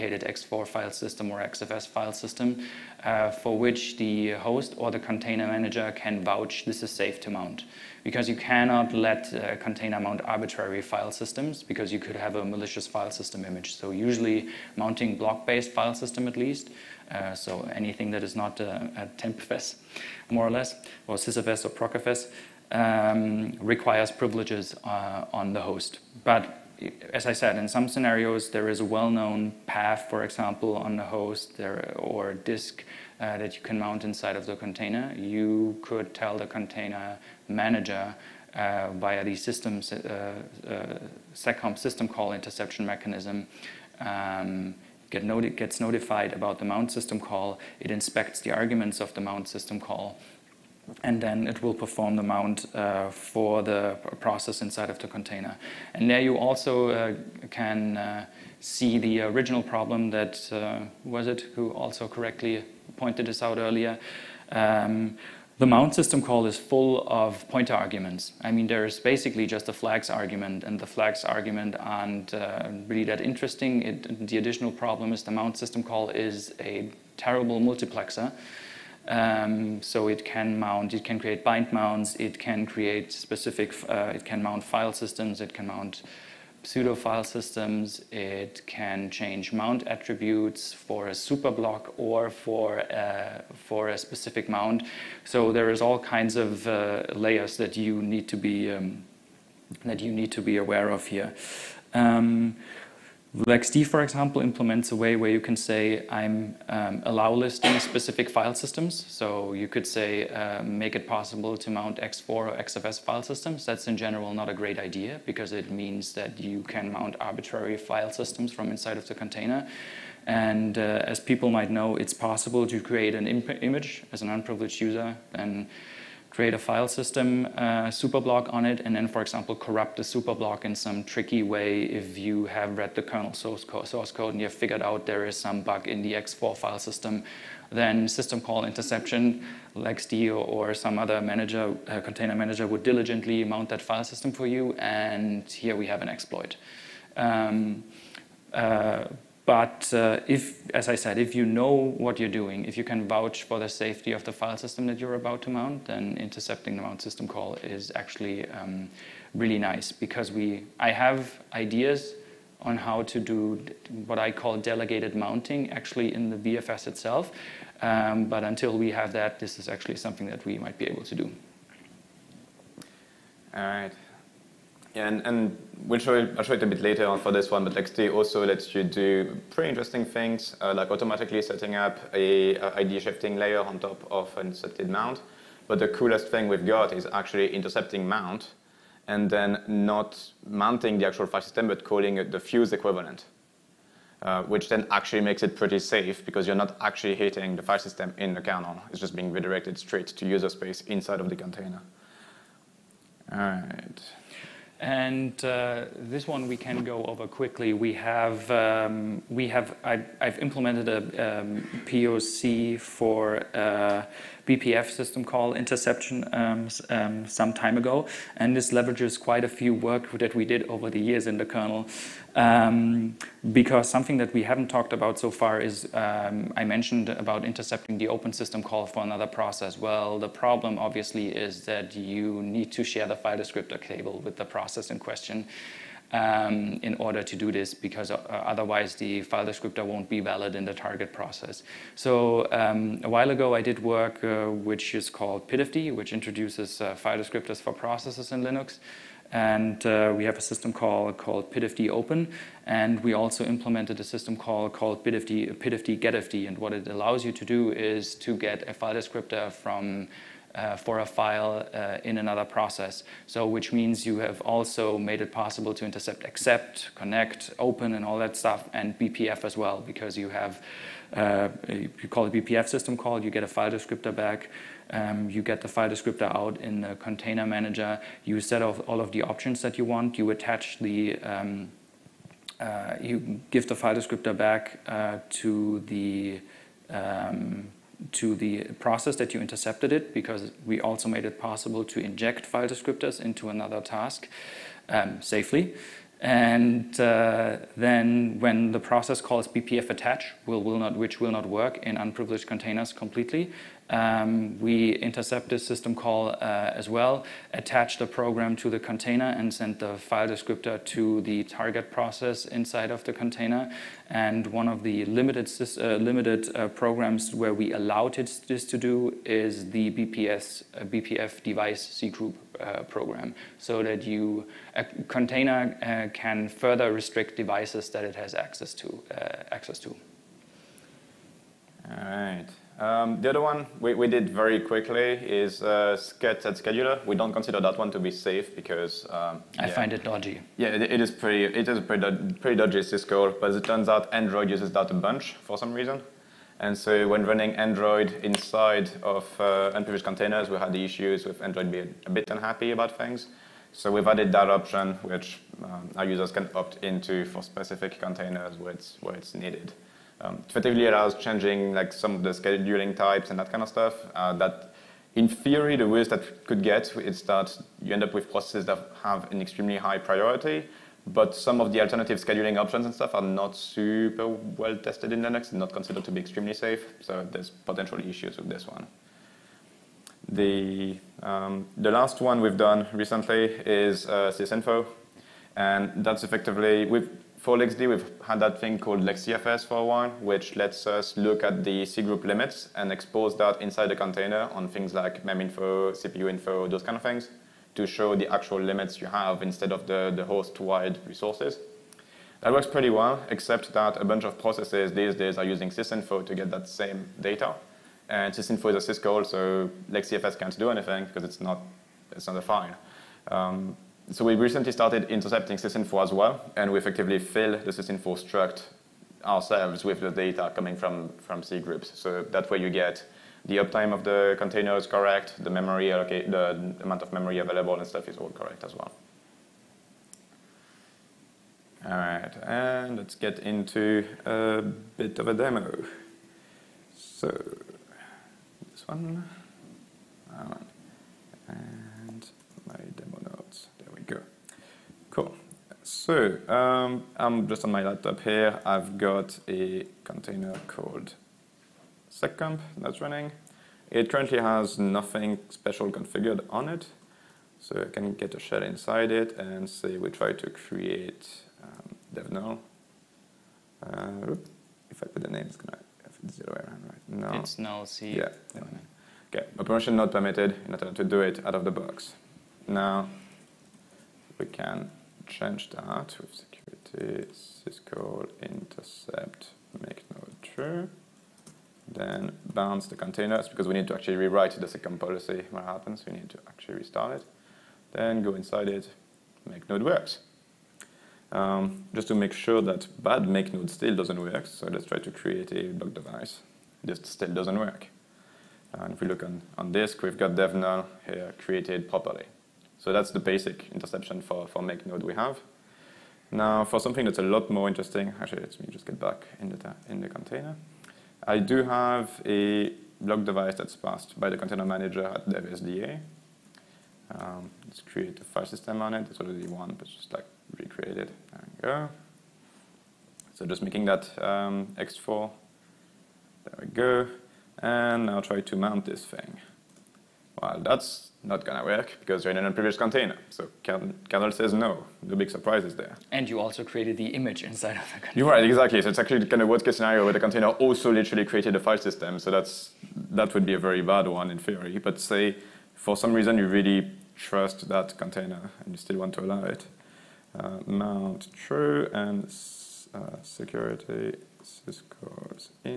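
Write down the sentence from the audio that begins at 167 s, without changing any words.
Um, but until we have that, this is actually something that we might be able to do.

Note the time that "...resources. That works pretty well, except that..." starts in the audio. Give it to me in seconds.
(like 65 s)
401 s.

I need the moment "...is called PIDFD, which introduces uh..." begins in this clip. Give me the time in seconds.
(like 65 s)
244 s.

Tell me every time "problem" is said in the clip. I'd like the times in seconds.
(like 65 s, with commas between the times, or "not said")
59 s, 74 s, 230 s.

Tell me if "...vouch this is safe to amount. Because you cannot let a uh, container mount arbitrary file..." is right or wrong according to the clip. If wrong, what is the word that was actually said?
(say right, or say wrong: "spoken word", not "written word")
wrong: "mount", not "amount".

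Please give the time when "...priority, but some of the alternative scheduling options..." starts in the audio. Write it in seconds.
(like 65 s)
369 s.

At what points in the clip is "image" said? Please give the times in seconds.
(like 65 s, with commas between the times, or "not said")
13 s, 123 s, 537 s.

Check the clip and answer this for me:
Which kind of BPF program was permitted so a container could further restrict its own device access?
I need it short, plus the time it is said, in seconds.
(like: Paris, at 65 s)
BPF device cgroup, at 320 s.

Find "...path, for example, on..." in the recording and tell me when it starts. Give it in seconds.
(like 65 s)
29 s.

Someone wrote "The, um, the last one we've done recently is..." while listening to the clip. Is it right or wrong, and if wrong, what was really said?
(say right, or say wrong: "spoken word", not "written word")
right.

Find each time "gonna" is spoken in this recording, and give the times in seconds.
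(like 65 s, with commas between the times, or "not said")
465 s, 531 s.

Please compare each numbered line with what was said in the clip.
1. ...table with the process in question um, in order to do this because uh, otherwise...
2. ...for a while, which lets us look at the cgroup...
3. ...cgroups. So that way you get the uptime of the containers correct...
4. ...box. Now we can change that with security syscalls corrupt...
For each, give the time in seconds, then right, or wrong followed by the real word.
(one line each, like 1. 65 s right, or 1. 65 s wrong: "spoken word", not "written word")
1. 233 s right
2. 389 s right
3. 421 s right
4. 471 s wrong: "intercept", not "corrupt".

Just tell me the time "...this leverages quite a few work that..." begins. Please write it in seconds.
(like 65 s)
218 s.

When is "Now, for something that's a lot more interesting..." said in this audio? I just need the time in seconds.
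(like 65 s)
506 s.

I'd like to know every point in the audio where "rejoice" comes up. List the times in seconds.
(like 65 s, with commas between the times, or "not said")
not said.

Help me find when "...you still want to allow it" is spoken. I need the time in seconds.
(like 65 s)
548 s.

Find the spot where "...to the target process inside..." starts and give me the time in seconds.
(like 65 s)
310 s.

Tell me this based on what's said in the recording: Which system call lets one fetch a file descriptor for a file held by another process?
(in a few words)
PIDFD GetFD.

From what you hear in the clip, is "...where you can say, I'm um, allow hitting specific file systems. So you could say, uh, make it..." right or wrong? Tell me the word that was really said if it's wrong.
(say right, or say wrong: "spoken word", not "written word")
wrong: "listing", not "hitting".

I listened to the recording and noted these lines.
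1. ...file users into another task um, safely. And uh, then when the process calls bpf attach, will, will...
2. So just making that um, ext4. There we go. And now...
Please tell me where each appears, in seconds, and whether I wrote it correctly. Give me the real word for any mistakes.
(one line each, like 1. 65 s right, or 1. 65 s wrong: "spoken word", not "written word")
1. 292 s wrong: "descriptors", not "users"
2. 523 s right.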